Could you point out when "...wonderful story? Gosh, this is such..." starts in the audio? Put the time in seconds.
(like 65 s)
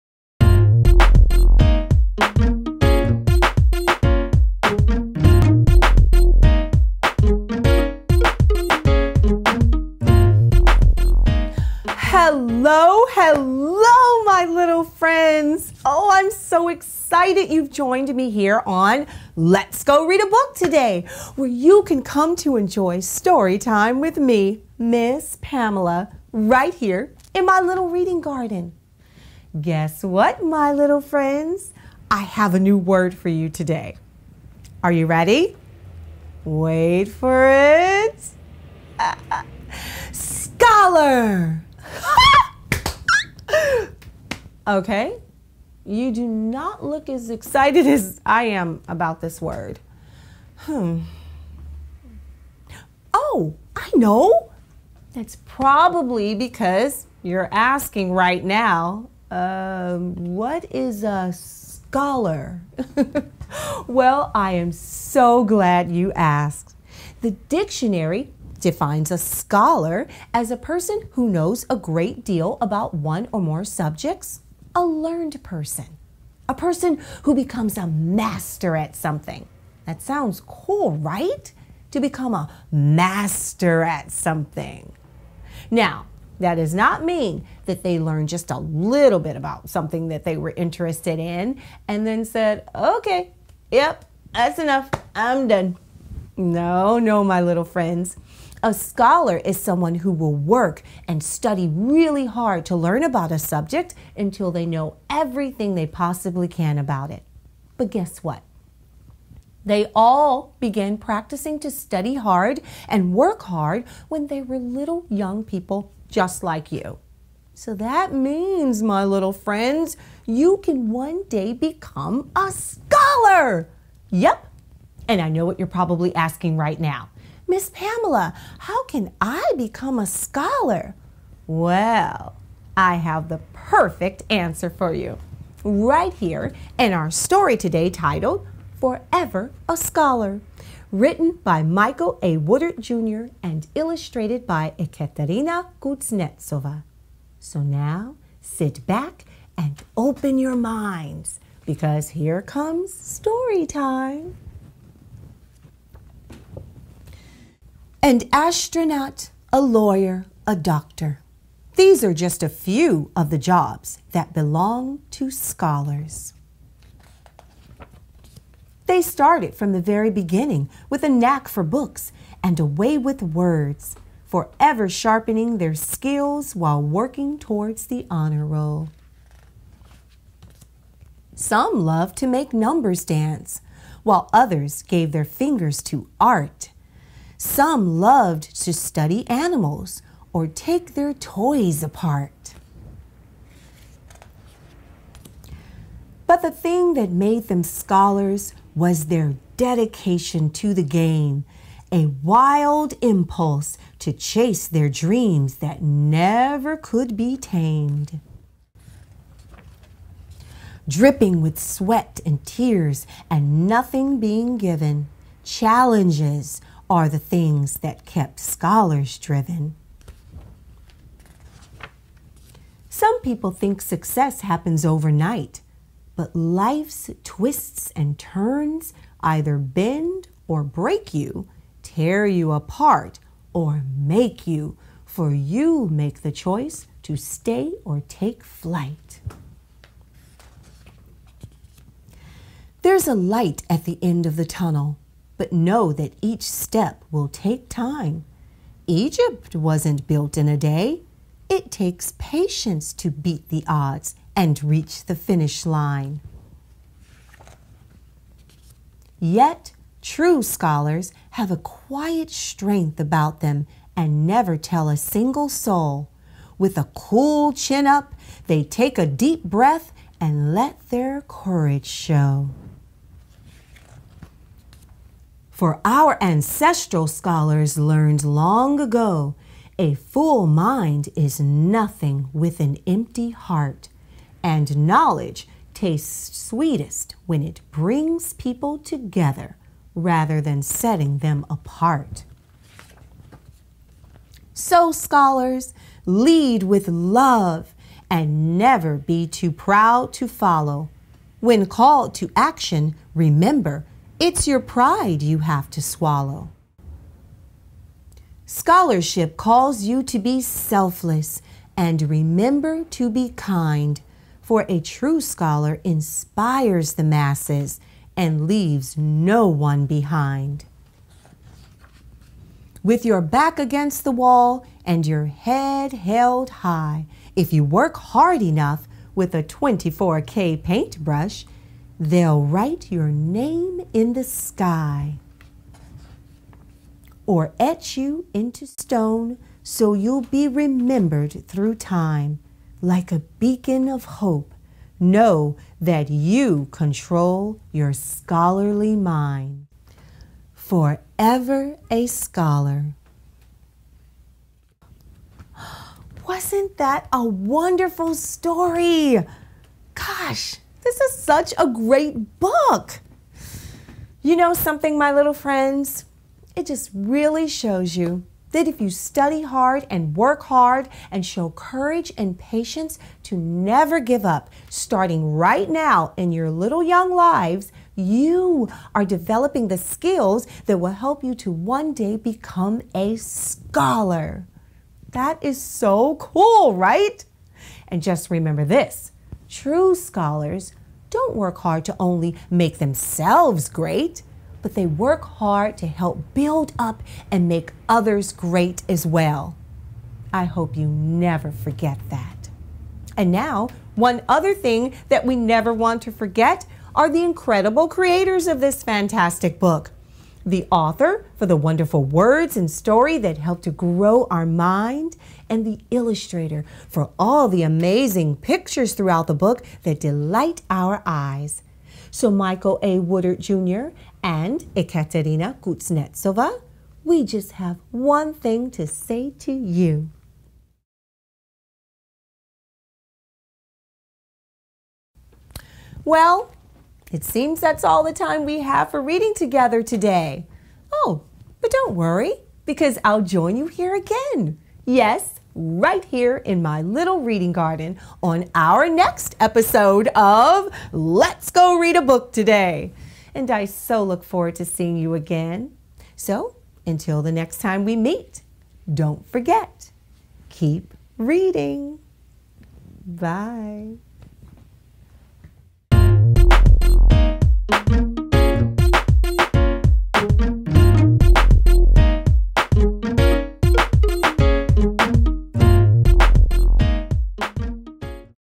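357 s.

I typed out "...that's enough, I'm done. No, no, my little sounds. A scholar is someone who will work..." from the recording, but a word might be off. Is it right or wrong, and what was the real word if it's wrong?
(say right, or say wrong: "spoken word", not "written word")
wrong: "friends", not "sounds".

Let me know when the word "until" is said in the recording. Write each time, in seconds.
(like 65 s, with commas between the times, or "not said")
104 s, 456 s.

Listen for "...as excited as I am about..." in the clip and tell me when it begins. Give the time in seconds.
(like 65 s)
47 s.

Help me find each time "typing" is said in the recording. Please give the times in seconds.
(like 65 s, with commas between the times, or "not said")
not said.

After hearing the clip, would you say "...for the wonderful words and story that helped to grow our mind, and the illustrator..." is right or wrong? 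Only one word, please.
right.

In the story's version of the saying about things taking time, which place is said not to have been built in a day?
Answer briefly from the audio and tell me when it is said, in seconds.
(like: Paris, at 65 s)
Egypt, at 248 s.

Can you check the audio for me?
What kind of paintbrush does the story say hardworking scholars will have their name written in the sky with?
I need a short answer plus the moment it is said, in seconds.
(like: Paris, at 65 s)
24K paintbrush, at 329 s.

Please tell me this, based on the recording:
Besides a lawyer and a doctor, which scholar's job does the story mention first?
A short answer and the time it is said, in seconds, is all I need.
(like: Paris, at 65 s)
astronaut, at 158 s.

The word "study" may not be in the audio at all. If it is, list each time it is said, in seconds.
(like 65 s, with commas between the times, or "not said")
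101 s, 111 s, 188 s, 368 s.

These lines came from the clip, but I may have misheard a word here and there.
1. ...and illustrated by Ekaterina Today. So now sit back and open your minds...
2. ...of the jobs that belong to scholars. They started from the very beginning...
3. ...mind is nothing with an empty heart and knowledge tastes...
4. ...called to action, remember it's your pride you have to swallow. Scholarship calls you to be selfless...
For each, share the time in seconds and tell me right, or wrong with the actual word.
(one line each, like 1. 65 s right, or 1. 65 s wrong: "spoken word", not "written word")
1. 143 s wrong: "Kuznetsova", not "Today"
2. 163 s right
3. 280 s right
4. 301 s right.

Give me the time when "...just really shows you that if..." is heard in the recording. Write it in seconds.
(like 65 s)
366 s.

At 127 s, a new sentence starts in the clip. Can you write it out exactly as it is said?
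Miss Pamela, how can I become a scholar?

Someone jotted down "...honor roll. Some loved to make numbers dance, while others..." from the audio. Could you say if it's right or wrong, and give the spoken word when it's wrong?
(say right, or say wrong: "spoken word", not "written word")
right.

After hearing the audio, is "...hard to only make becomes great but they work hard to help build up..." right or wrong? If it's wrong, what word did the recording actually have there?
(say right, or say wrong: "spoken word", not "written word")
wrong: "themselves", not "becomes".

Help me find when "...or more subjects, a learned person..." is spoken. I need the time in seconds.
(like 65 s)
73 s.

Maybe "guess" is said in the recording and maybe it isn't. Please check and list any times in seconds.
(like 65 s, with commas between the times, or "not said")
29 s, 107 s.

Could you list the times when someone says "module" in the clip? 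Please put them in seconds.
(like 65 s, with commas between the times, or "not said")
not said.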